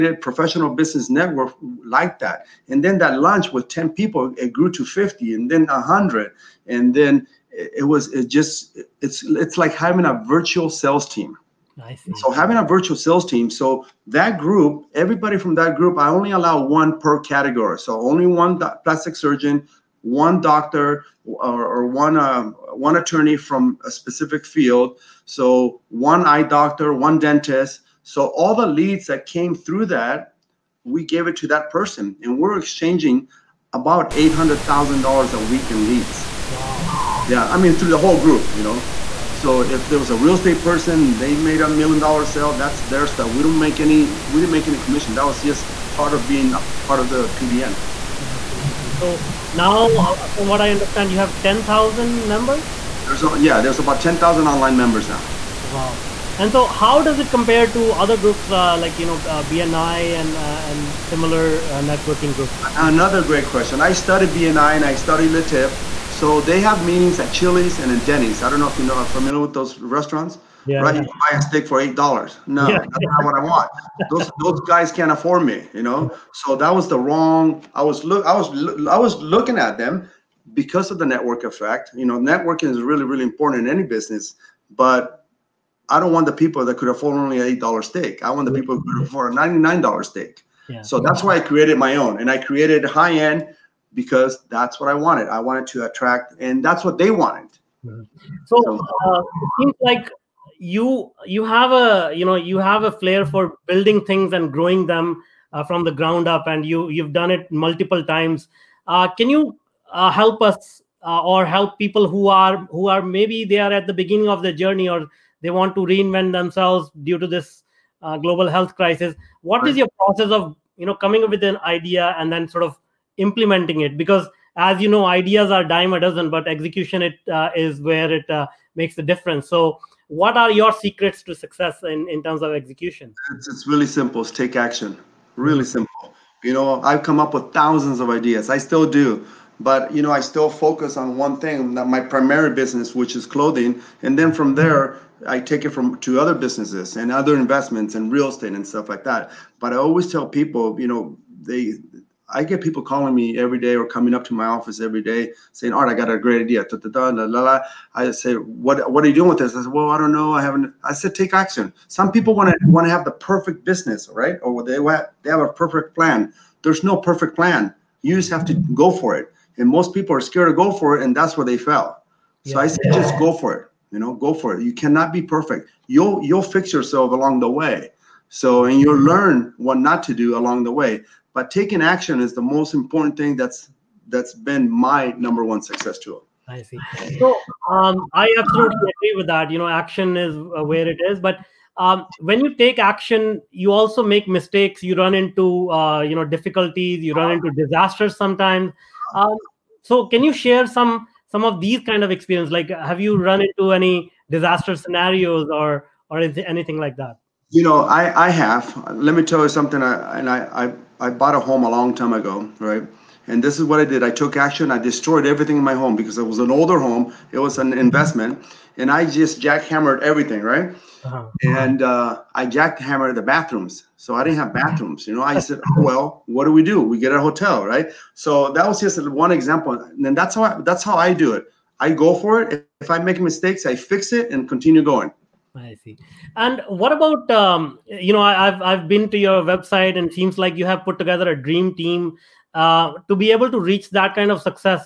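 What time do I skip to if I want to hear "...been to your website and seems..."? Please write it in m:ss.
3:58.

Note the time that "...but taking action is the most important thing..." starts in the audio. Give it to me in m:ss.
3:01.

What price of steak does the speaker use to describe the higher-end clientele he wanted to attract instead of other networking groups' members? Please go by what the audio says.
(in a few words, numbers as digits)
$99.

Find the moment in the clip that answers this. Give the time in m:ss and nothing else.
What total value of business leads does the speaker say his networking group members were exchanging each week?
0:34.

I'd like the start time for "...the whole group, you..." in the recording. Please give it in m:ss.
0:37.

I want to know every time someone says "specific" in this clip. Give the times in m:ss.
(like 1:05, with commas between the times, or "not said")
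0:23.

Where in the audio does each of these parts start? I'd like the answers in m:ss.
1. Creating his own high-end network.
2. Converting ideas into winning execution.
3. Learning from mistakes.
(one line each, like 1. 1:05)
1. 1:02
2. 2:13
3. 3:28.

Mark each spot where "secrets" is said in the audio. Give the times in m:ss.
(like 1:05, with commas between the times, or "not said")
2:10.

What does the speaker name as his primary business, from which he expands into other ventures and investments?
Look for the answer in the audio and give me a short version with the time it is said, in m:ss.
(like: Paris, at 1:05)
Clothing, at 2:23.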